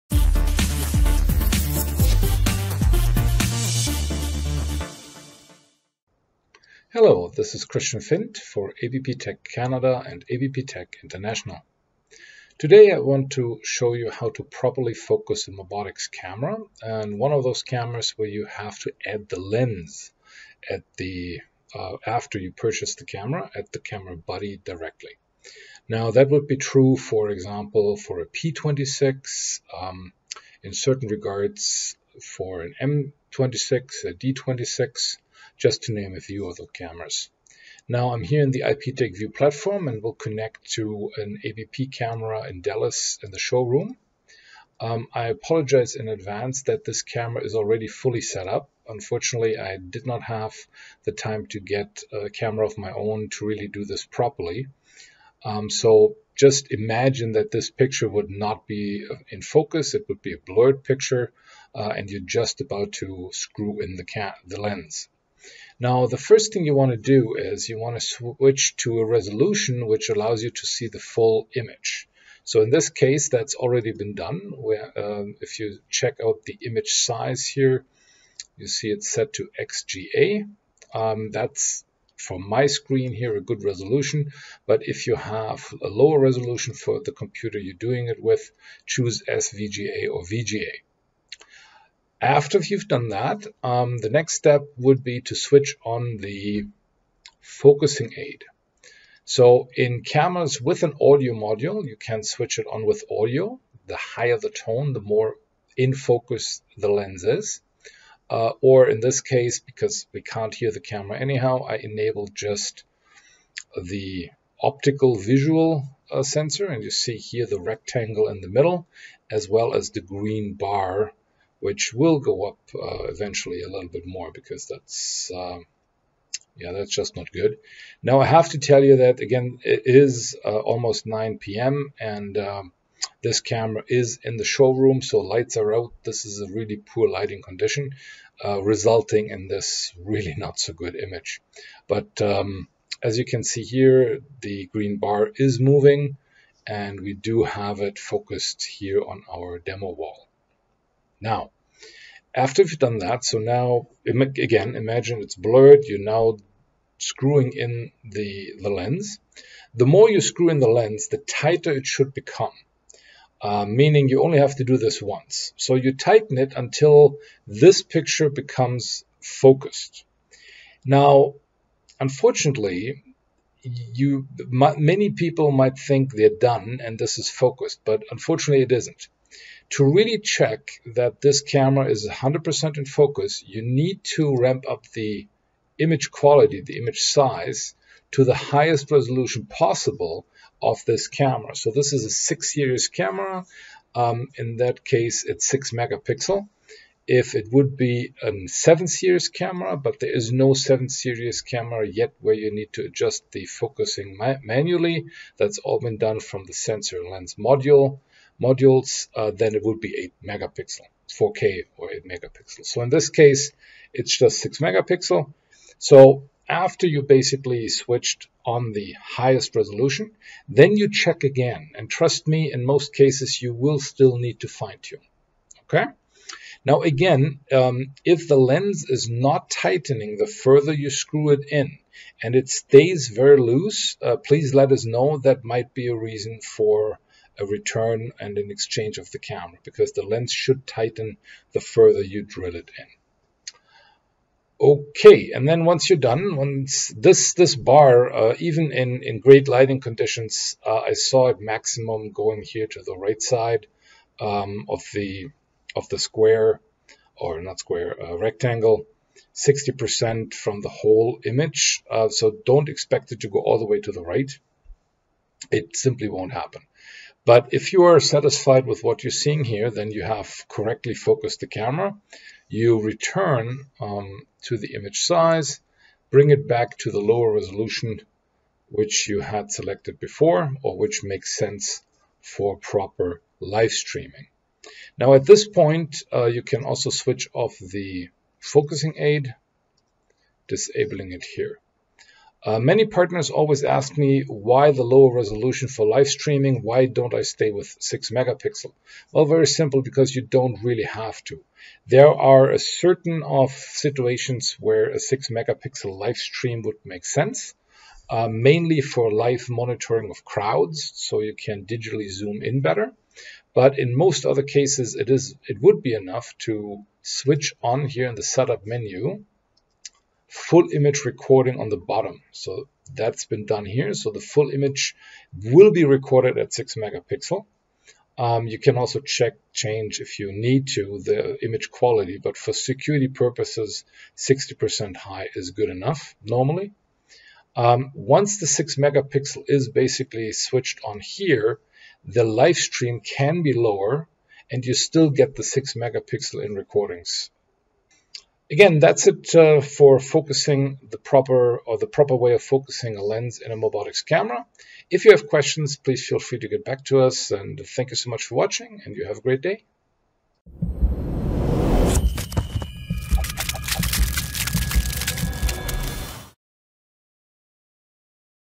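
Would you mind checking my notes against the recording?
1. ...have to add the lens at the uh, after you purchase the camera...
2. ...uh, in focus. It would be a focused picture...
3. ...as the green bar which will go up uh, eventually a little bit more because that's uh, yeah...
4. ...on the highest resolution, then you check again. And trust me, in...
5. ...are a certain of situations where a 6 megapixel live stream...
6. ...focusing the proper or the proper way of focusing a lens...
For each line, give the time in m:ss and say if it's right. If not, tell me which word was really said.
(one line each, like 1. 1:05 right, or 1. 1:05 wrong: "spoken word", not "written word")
1. 0:18 right
2. 0:59 wrong: "blurred", not "focused"
3. 1:59 right
4. 3:38 right
5. 5:02 right
6. 5:49 right.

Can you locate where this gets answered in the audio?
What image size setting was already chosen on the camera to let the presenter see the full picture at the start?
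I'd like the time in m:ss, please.
1:19.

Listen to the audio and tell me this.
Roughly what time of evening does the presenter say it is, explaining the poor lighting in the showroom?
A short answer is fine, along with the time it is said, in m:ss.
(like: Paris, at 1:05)
9 p.m., at 2:11.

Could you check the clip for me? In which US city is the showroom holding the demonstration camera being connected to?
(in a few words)
Dallas.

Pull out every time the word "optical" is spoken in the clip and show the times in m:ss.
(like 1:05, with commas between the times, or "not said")
1:54.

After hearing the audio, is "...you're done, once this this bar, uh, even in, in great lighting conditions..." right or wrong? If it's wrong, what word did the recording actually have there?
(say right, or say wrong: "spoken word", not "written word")
right.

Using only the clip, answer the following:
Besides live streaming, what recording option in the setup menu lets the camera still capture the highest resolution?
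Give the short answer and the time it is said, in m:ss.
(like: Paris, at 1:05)
full image recording, at 5:20.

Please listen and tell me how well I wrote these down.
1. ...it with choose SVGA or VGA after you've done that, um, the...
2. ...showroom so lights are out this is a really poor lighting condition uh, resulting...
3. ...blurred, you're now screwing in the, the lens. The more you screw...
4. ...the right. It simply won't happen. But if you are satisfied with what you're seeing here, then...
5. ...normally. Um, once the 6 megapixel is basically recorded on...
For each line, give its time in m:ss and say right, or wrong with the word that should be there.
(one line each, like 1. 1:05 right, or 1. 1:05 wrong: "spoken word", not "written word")
1. 1:28 right
2. 2:14 right
3. 2:35 right
4. 4:23 right
5. 5:36 wrong: "switched", not "recorded".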